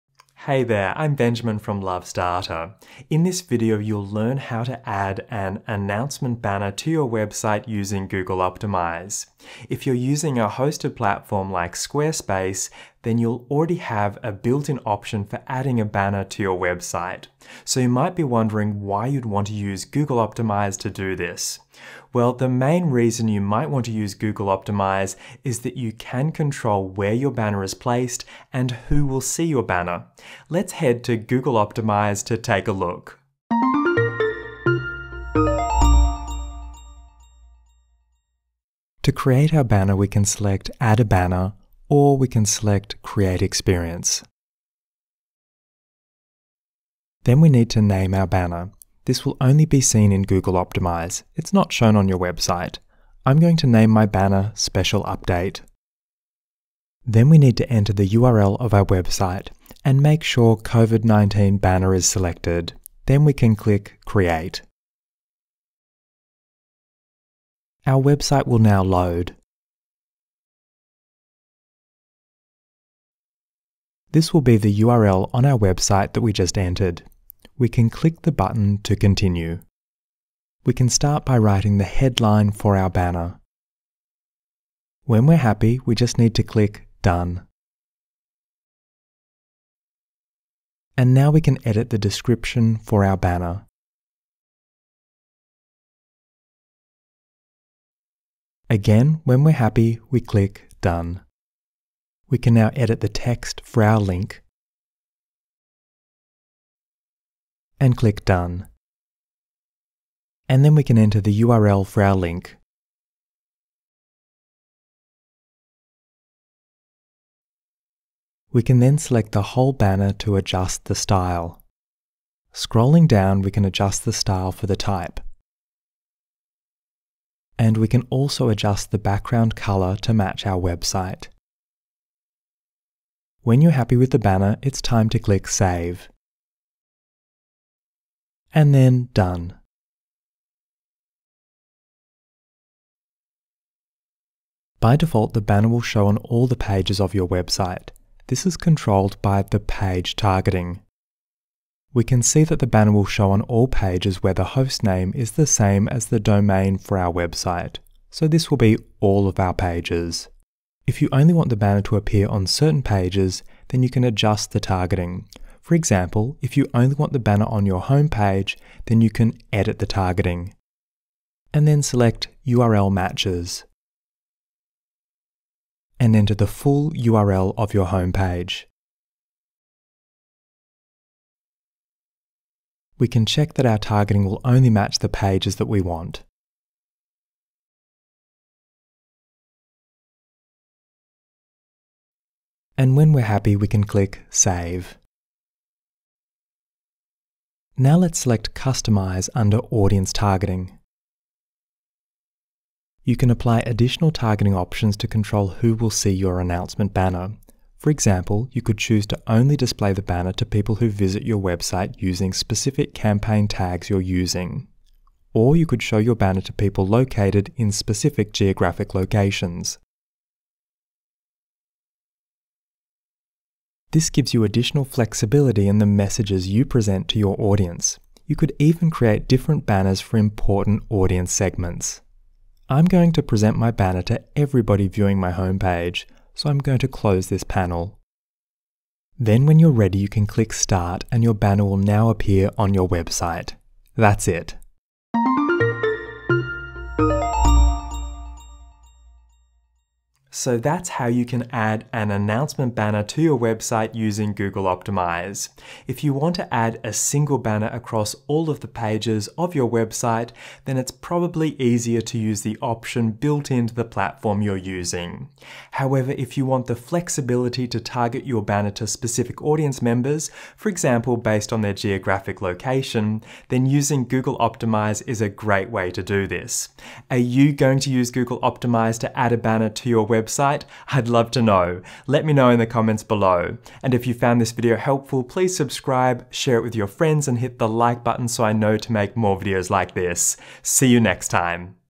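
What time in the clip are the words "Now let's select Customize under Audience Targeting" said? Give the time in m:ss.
3:17.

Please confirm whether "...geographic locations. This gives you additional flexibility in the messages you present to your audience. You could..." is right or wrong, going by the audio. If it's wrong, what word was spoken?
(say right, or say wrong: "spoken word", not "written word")
right.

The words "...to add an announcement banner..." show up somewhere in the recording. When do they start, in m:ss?
0:04.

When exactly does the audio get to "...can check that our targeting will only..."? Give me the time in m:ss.
3:03.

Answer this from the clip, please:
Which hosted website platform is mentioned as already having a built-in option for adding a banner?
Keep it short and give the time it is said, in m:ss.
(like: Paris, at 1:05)
Squarespace, at 0:11.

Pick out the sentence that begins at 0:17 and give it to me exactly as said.
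So you might be wondering why you'd want to use Google Optimize to do this.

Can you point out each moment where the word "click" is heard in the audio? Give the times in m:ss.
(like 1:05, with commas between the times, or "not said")
1:03, 1:17, 1:26, 1:40, 1:47, 2:15, 3:13, 4:00.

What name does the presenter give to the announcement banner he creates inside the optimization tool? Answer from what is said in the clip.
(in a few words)
Special Update.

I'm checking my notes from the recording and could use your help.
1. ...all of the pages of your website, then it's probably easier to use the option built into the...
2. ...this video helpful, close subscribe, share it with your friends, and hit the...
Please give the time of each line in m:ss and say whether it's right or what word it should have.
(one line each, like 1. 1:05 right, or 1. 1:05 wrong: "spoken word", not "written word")
1. 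4:18 right
2. 4:44 wrong: "please", not "close".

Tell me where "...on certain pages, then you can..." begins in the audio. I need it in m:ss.
2:42.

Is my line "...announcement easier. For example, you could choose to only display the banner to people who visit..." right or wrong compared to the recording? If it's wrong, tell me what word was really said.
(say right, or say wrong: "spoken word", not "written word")
wrong: "banner", not "easier".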